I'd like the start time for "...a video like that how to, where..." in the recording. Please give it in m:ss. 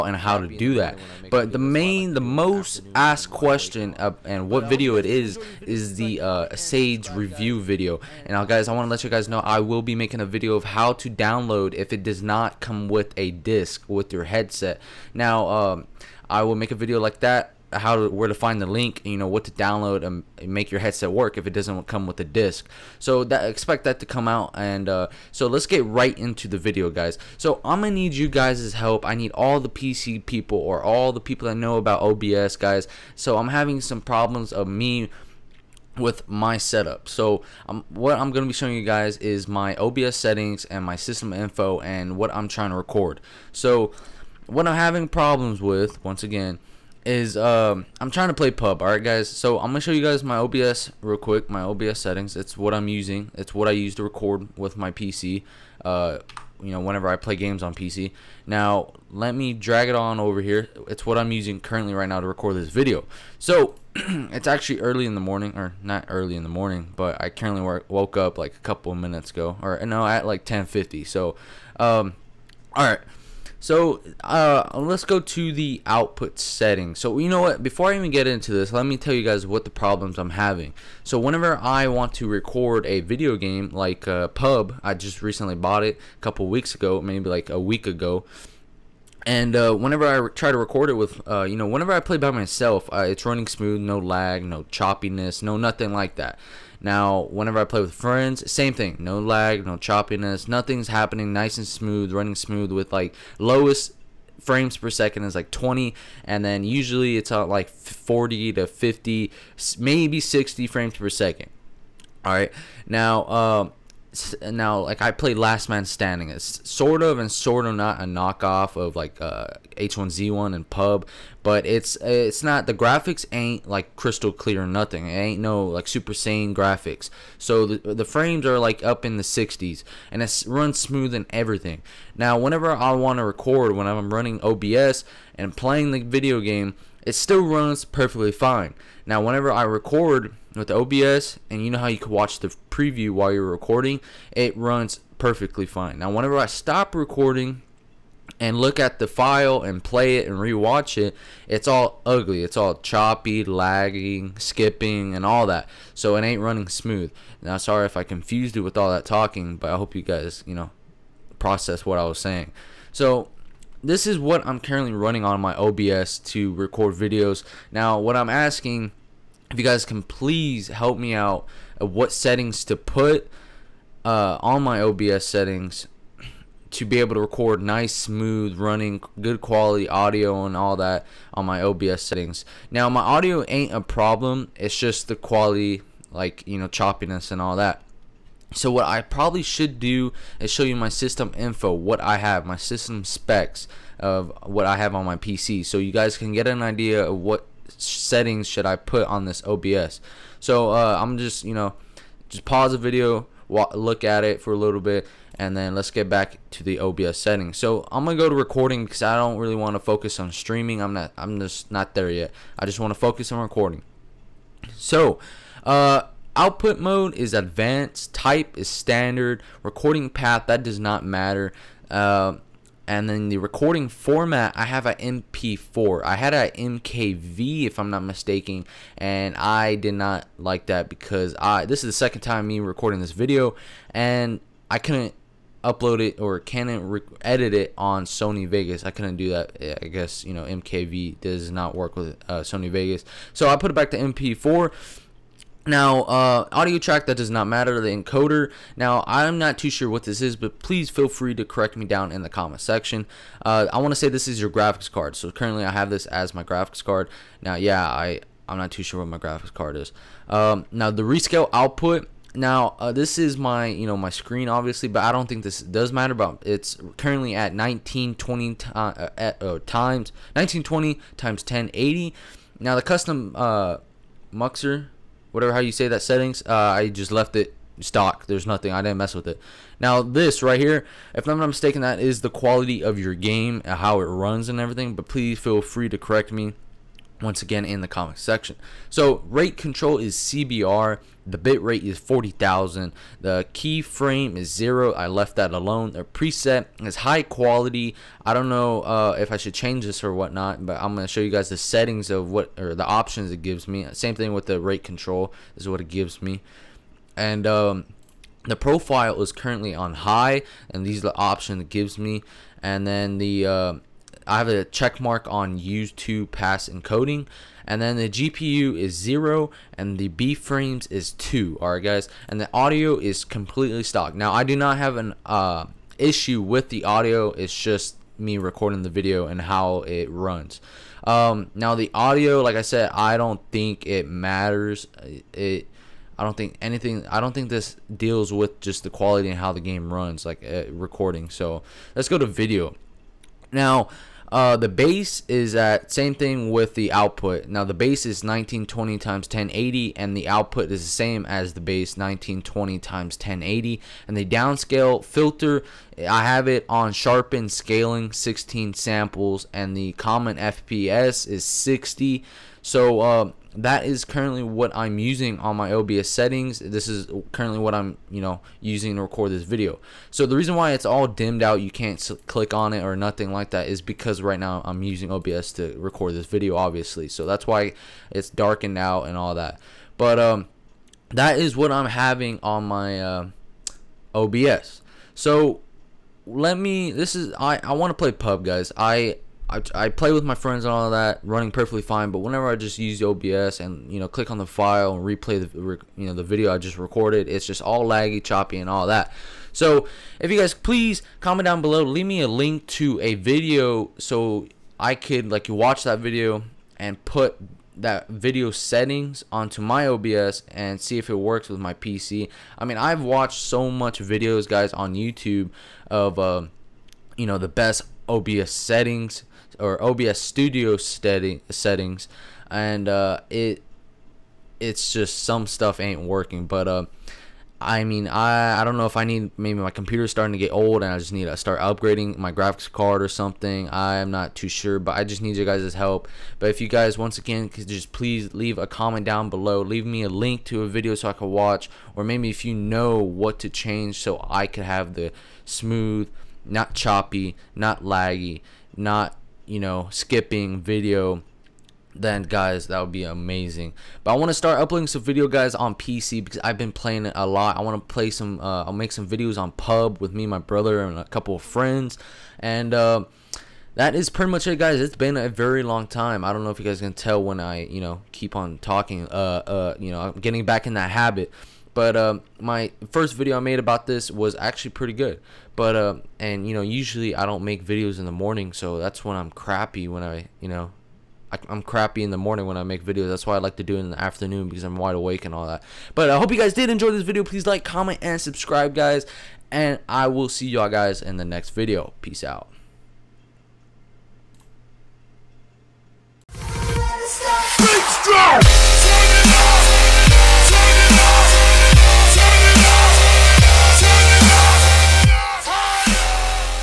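0:16.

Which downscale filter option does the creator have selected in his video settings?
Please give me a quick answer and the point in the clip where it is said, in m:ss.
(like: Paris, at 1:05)
sharpen scaling, at 5:56.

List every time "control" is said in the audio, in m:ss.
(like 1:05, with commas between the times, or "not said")
4:49, 5:04.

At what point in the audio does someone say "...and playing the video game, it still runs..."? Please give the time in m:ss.
2:15.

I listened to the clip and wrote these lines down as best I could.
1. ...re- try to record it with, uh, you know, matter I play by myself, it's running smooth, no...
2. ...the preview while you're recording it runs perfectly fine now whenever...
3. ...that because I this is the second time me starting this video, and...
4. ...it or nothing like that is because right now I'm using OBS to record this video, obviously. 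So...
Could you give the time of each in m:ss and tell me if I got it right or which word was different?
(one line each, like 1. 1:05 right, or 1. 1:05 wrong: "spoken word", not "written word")
1. 1:30 wrong: "whenever", not "matter"
2. 2:22 right
3. 3:50 wrong: "recording", not "starting"
4. 6:12 right.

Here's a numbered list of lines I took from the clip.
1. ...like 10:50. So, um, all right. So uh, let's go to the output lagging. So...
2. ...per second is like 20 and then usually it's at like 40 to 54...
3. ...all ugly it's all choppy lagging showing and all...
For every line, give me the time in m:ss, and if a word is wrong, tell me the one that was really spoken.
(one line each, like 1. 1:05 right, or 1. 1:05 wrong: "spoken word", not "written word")
1. 1:10 wrong: "setting", not "lagging"
2. 1:44 wrong: "50", not "54"
3. 2:31 wrong: "skipping", not "showing".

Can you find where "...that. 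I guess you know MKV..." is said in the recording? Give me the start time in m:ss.
3:59.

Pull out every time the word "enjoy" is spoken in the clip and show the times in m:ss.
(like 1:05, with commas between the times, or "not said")
8:06.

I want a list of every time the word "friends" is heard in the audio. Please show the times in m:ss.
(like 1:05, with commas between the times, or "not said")
1:37, 6:30, 7:41.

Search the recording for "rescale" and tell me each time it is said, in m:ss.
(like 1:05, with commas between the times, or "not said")
4:21.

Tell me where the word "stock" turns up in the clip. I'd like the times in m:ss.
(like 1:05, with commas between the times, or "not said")
4:37, 5:23.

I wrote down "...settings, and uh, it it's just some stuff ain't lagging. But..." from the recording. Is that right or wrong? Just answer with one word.
wrong.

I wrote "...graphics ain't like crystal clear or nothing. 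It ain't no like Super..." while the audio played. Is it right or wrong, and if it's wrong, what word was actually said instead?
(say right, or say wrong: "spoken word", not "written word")
right.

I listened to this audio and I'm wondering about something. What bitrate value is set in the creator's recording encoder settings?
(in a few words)
40000.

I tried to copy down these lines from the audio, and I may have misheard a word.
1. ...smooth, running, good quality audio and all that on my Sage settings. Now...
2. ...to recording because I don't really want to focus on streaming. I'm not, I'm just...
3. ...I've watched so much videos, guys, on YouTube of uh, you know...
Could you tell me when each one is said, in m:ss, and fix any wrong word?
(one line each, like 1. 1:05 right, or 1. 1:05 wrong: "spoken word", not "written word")
1. 2:57 wrong: "OBS", not "Sage"
2. 3:28 right
3. 6:52 right.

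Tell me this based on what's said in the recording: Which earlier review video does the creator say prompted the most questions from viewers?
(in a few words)
Sage review.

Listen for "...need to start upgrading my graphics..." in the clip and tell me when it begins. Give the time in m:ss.
7:11.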